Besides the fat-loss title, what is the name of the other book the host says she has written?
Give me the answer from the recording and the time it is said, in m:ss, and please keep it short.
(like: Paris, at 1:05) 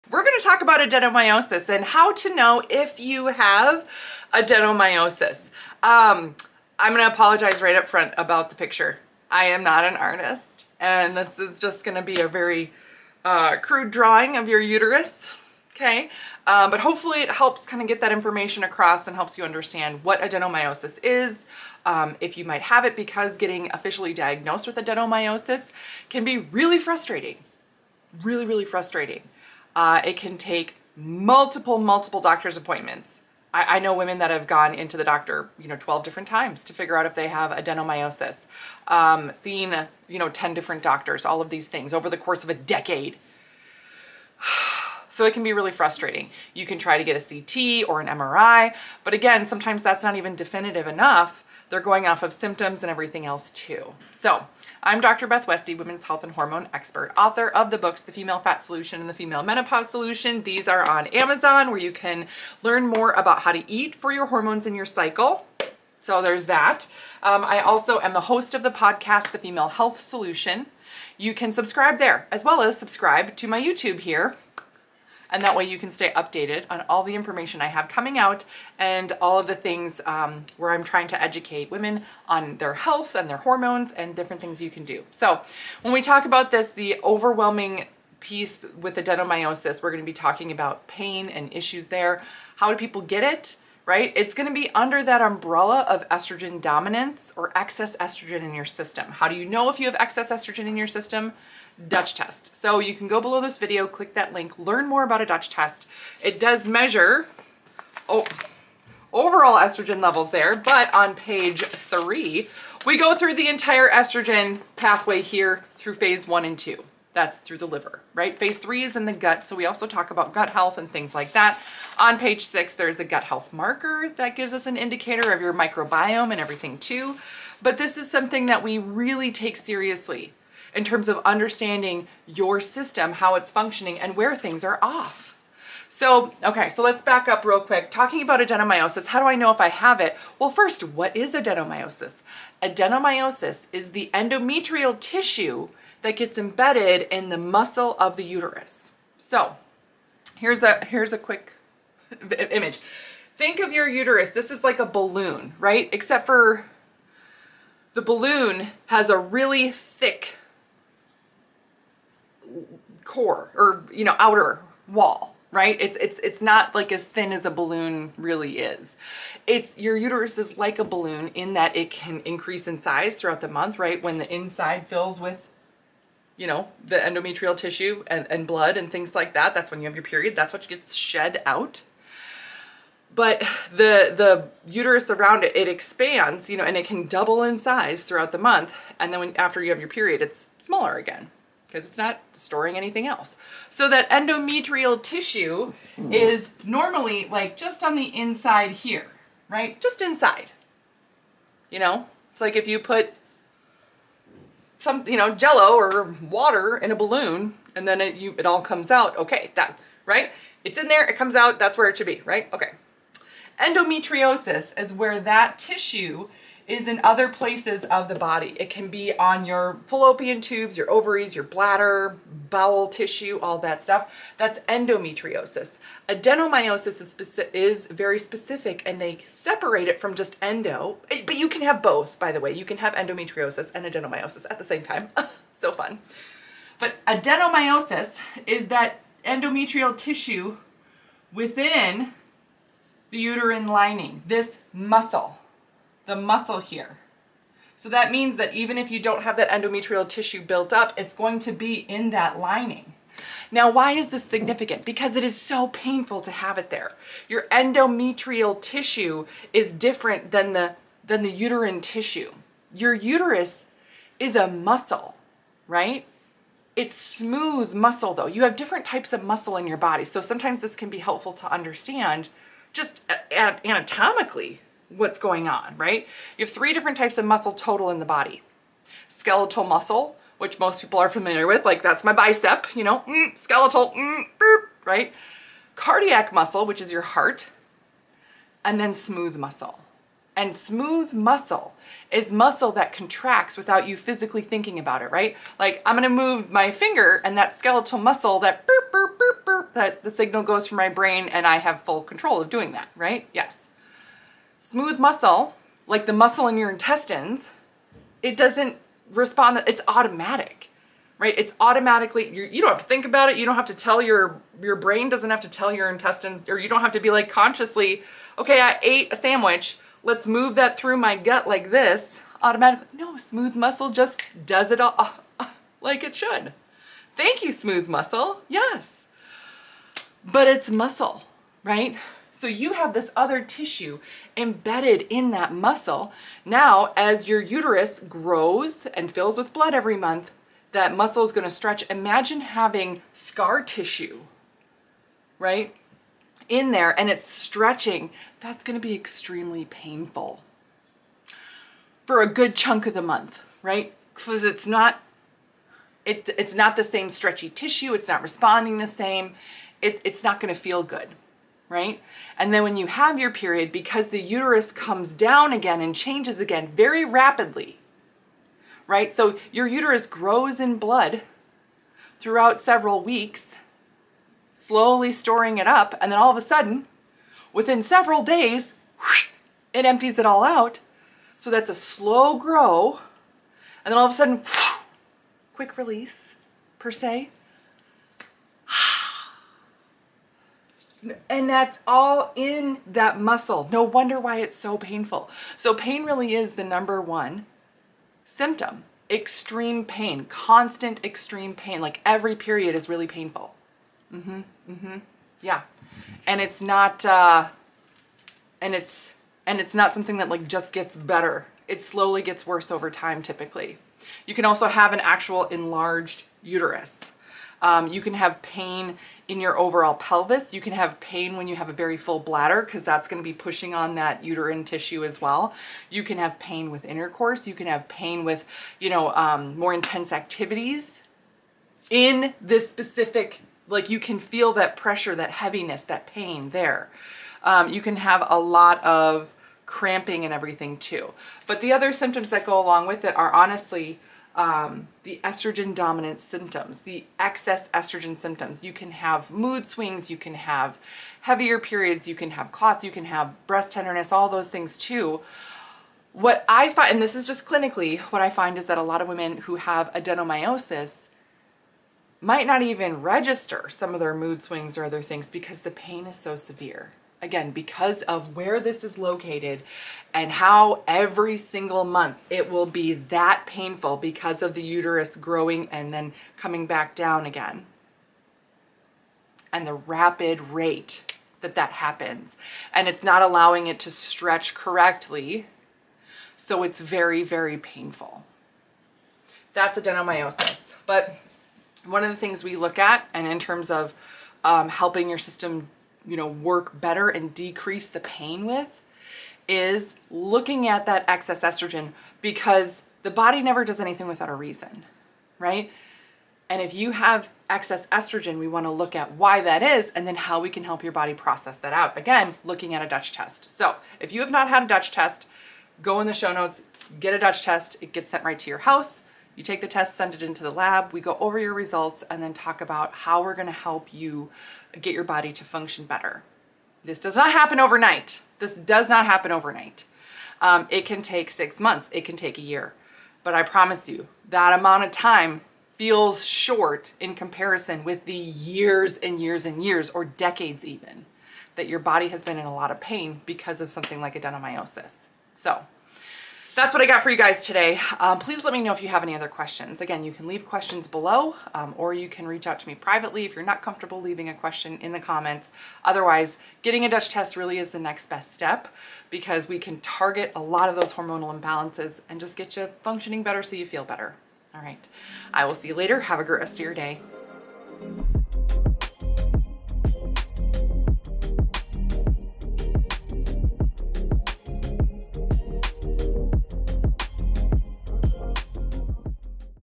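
The Female Menopause Solution, at 0:59.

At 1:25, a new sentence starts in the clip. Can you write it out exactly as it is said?
So when we talk about this, the overwhelming piece with adenomyosis, we're going to be talking about pain and issues there.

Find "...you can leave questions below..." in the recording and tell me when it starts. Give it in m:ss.
9:10.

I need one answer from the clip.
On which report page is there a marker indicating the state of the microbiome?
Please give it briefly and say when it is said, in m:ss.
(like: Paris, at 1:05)
6, at 2:02.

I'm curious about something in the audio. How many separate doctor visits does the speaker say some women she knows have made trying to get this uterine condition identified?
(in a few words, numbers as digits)
12.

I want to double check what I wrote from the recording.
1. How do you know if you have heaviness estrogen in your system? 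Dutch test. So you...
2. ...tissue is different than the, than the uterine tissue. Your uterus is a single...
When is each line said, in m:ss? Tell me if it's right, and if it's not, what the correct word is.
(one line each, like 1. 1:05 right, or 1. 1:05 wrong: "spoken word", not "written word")
1. 1:39 wrong: "excess", not "heaviness"
2. 4:18 wrong: "muscle", not "single".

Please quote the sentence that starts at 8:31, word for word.
Again, looking at a Dutch test.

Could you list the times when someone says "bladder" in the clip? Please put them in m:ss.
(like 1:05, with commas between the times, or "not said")
3:41, 7:02.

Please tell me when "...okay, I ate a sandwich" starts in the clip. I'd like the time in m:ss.
5:18.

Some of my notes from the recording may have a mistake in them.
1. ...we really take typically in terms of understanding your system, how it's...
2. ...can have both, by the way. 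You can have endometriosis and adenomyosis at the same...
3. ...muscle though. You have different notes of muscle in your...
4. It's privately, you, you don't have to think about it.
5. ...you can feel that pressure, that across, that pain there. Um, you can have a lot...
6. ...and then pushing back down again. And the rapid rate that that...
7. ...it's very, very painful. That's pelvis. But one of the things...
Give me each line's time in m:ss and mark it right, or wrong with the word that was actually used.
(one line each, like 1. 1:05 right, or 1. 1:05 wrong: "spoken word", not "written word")
1. 2:08 wrong: "seriously", not "typically"
2. 3:51 right
3. 4:27 wrong: "types", not "notes"
4. 5:11 wrong: "automatically", not "privately"
5. 7:13 wrong: "heaviness", not "across"
6. 7:55 wrong: "coming", not "pushing"
7. 8:06 wrong: "adenomyosis", not "pelvis".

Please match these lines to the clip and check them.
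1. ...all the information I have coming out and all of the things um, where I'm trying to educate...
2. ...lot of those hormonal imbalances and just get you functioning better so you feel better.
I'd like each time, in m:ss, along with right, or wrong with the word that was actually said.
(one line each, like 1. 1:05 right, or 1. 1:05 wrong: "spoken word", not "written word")
1. 1:16 right
2. 9:20 right.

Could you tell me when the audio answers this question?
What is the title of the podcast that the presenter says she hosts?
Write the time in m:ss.
1:09.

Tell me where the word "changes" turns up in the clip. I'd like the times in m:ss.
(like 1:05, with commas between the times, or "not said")
6:05.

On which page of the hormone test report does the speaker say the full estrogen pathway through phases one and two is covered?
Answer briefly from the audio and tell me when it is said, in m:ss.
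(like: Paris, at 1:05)
3, at 1:51.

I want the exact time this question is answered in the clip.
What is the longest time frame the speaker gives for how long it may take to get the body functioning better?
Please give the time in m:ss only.
8:52.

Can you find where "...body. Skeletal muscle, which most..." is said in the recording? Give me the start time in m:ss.
4:38.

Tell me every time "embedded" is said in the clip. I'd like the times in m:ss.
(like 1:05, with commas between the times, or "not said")
2:26, 5:34.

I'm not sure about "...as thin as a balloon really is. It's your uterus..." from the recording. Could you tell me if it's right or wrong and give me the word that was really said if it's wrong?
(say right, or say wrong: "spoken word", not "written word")
right.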